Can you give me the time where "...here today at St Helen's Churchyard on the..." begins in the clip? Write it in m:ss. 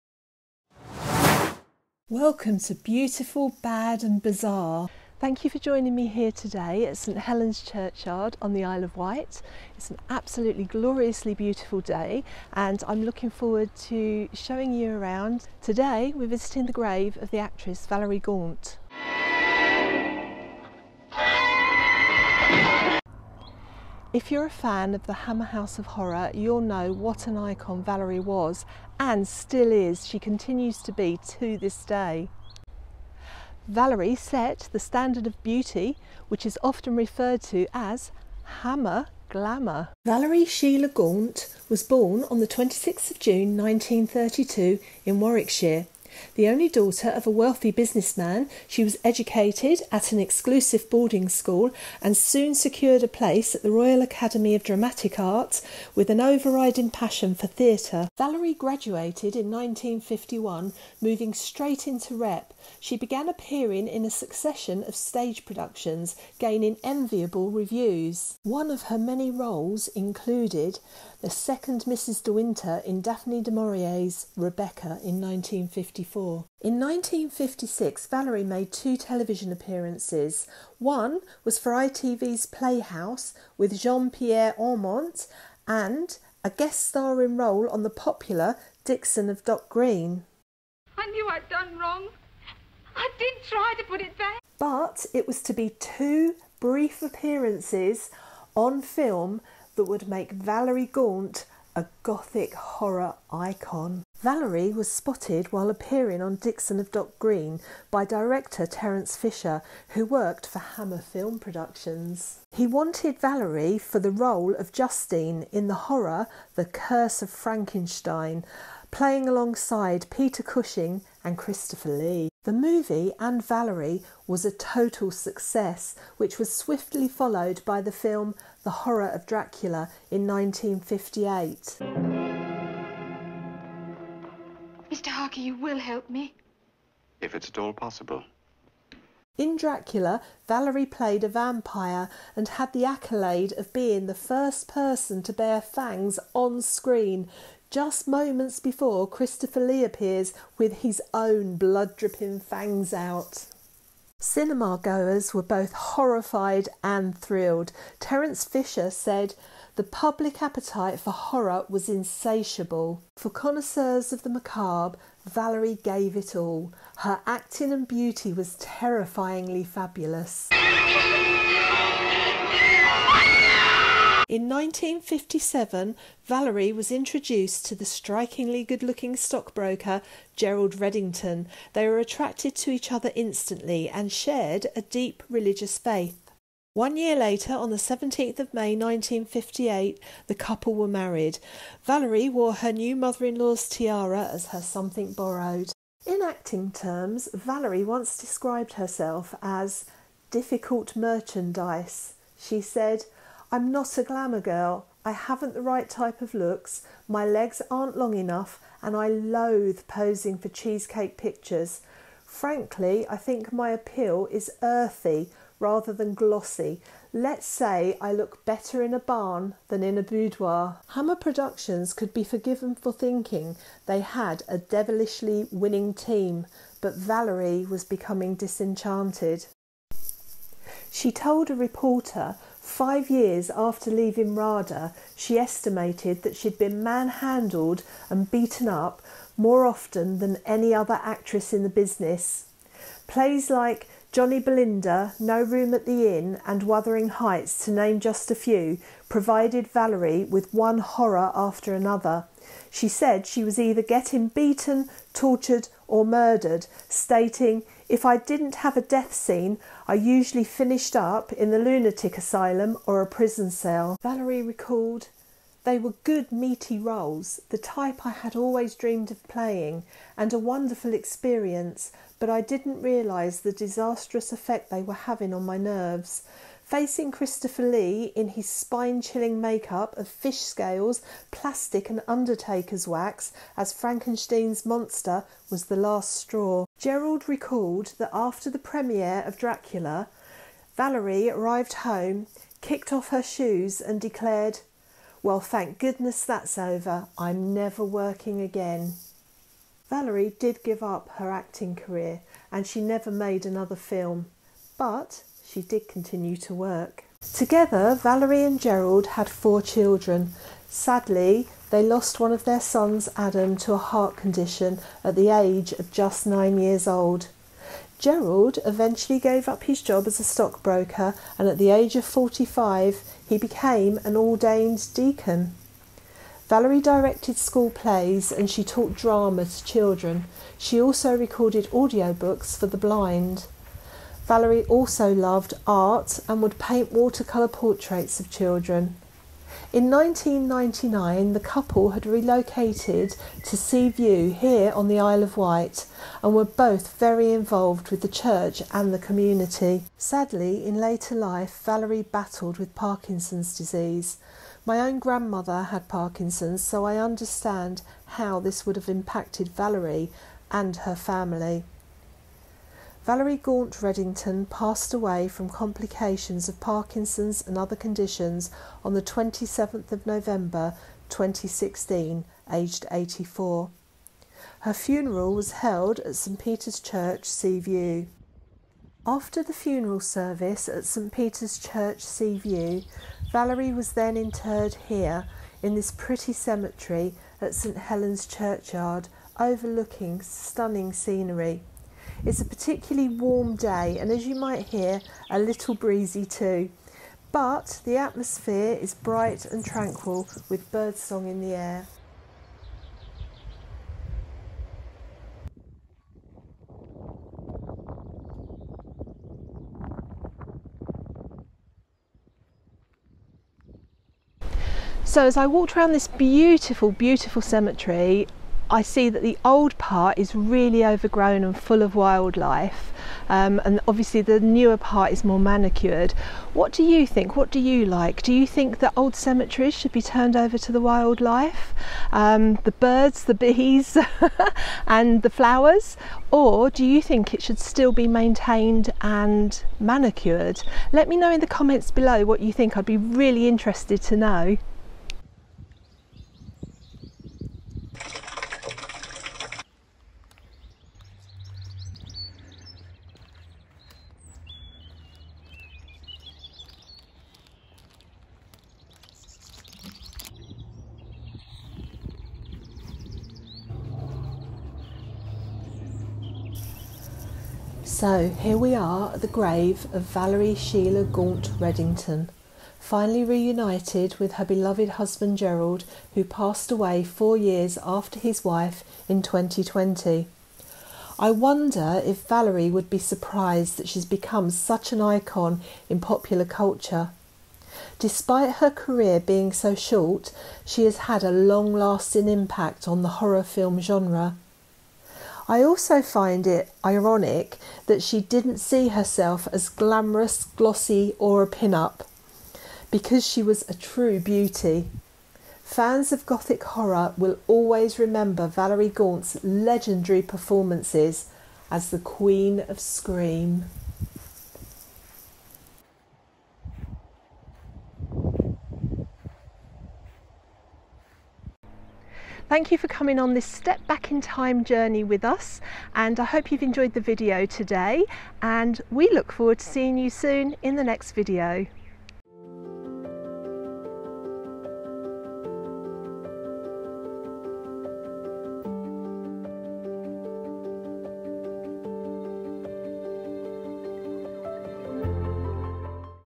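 0:06.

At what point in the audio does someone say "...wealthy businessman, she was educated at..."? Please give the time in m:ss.
0:47.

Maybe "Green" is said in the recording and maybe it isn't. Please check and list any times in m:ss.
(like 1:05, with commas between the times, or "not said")
1:29, 1:47.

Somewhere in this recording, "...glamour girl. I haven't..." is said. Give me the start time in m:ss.
3:24.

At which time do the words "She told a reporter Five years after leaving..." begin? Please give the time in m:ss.
3:50.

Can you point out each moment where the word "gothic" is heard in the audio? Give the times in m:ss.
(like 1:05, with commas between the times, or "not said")
1:42, 8:26.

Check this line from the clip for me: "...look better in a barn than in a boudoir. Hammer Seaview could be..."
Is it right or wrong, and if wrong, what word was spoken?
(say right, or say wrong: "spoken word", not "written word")
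wrong: "Productions", not "Seaview".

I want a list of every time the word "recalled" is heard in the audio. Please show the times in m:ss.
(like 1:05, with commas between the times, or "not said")
4:24, 4:47.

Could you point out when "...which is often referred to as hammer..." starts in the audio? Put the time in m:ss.
0:36.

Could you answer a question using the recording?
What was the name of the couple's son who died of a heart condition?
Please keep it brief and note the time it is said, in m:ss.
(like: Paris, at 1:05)
Adam, at 5:13.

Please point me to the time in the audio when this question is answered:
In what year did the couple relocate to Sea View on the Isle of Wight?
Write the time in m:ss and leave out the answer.
5:39.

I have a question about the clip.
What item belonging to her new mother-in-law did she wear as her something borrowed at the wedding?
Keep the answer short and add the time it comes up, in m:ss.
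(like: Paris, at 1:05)
Tiara, at 3:13.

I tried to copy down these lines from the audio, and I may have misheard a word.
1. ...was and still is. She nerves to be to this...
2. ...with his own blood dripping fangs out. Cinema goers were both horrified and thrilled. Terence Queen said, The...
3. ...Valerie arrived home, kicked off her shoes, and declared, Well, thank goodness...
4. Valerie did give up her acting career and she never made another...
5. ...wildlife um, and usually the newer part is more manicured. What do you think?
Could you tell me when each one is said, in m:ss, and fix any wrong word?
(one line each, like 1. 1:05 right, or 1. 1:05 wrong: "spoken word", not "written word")
1. 0:28 wrong: "continues", not "nerves"
2. 2:30 wrong: "Fisher", not "Queen"
3. 4:50 right
4. 4:59 right
5. 7:01 wrong: "obviously", not "usually".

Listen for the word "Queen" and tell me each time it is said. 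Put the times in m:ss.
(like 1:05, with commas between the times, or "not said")
8:31.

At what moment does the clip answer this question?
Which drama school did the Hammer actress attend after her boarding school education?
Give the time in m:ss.
0:53.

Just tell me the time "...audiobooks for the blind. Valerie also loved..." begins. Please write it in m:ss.
5:31.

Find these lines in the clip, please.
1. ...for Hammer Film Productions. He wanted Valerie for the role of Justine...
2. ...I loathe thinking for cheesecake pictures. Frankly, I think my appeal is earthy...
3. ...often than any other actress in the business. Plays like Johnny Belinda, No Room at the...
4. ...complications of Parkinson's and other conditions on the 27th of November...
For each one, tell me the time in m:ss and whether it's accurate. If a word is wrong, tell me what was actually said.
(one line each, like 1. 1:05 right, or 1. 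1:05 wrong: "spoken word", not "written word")
1. 1:50 right
2. 3:28 wrong: "posing", not "thinking"
3. 3:59 right
4. 6:05 right.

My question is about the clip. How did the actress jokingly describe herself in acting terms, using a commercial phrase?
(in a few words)
Difficult merchandise.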